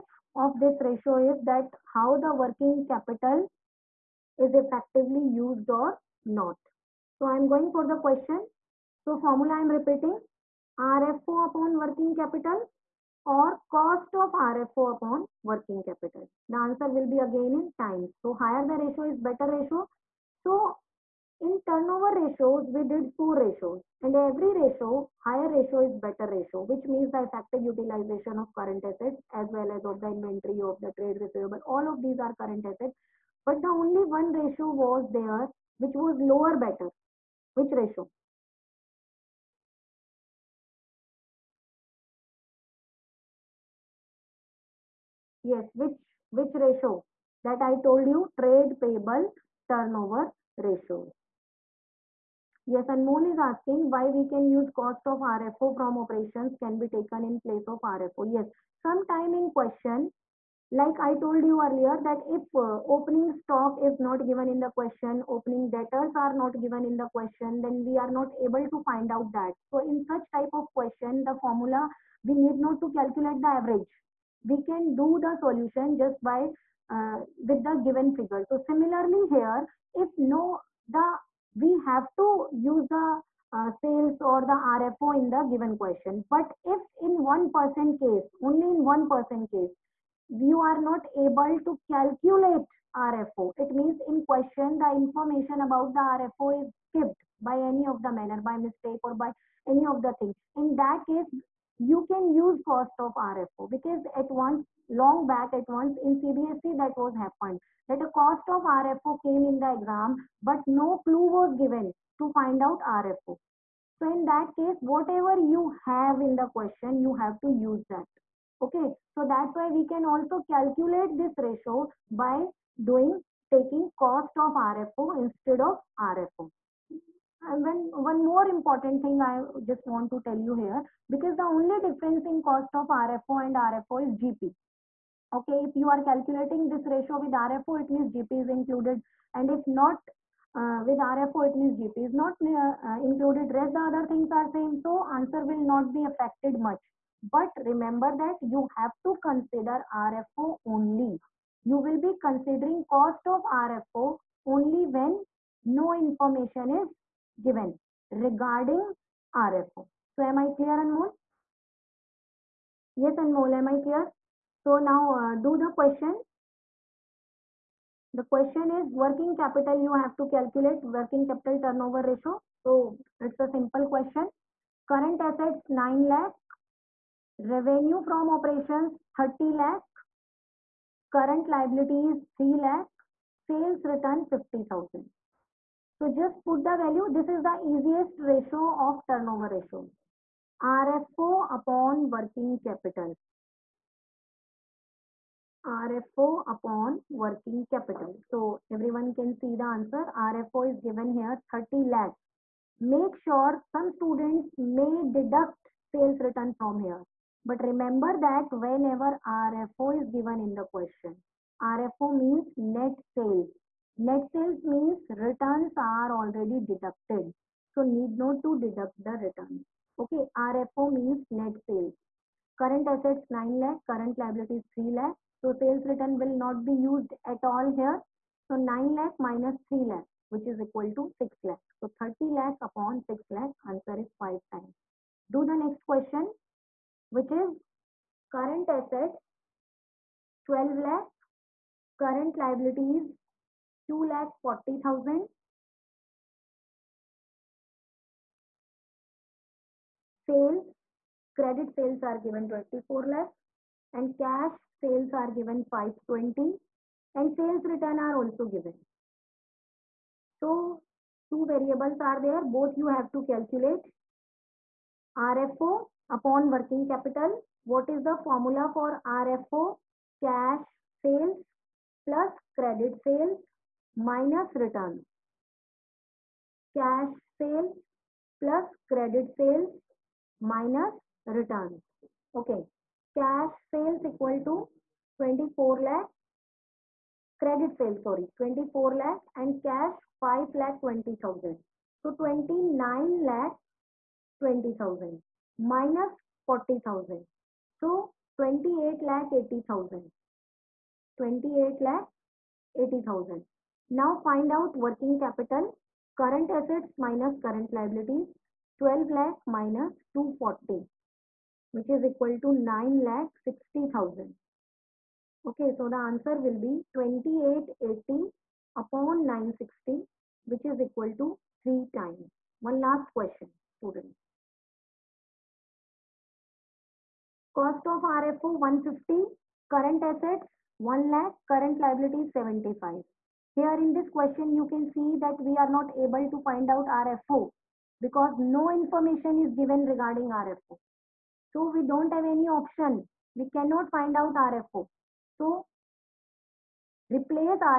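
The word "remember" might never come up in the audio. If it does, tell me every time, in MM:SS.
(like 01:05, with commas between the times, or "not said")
02:27, 03:27.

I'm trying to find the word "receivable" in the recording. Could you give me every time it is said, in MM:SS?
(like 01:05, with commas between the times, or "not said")
00:31.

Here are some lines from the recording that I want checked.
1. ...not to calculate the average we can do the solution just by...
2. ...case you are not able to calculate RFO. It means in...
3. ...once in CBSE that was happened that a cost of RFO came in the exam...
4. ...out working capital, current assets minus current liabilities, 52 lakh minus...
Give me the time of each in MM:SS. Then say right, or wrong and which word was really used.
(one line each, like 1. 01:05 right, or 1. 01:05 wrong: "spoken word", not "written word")
1. 01:12 right
2. 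01:29 right
3. 01:45 right
4. 05:04 wrong: "12", not "52".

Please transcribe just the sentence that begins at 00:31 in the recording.
All of these are current asset, but the only one ratio was there, which was lower better.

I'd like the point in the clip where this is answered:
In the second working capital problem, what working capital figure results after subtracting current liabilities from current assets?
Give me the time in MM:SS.
05:12.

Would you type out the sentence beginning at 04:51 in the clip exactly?
So 29 lakh 20,000 minus 40,000.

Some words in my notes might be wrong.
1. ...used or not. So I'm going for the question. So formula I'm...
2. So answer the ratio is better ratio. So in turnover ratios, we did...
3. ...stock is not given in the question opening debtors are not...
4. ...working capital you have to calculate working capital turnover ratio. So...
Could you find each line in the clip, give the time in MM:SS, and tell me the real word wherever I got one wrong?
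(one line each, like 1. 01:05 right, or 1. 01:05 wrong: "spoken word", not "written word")
1. 00:05 right
2. 00:18 wrong: "higher", not "answer"
3. 01:03 right
4. 02:48 right.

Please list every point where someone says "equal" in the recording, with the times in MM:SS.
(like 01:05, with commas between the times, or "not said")
03:50, 04:44, 05:12, 05:20.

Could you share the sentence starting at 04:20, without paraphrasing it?
So two variables are there, both you have to calculate.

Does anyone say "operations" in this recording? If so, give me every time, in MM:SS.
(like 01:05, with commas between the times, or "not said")
00:56, 02:58.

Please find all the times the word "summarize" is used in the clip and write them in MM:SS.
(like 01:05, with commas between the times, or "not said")
not said.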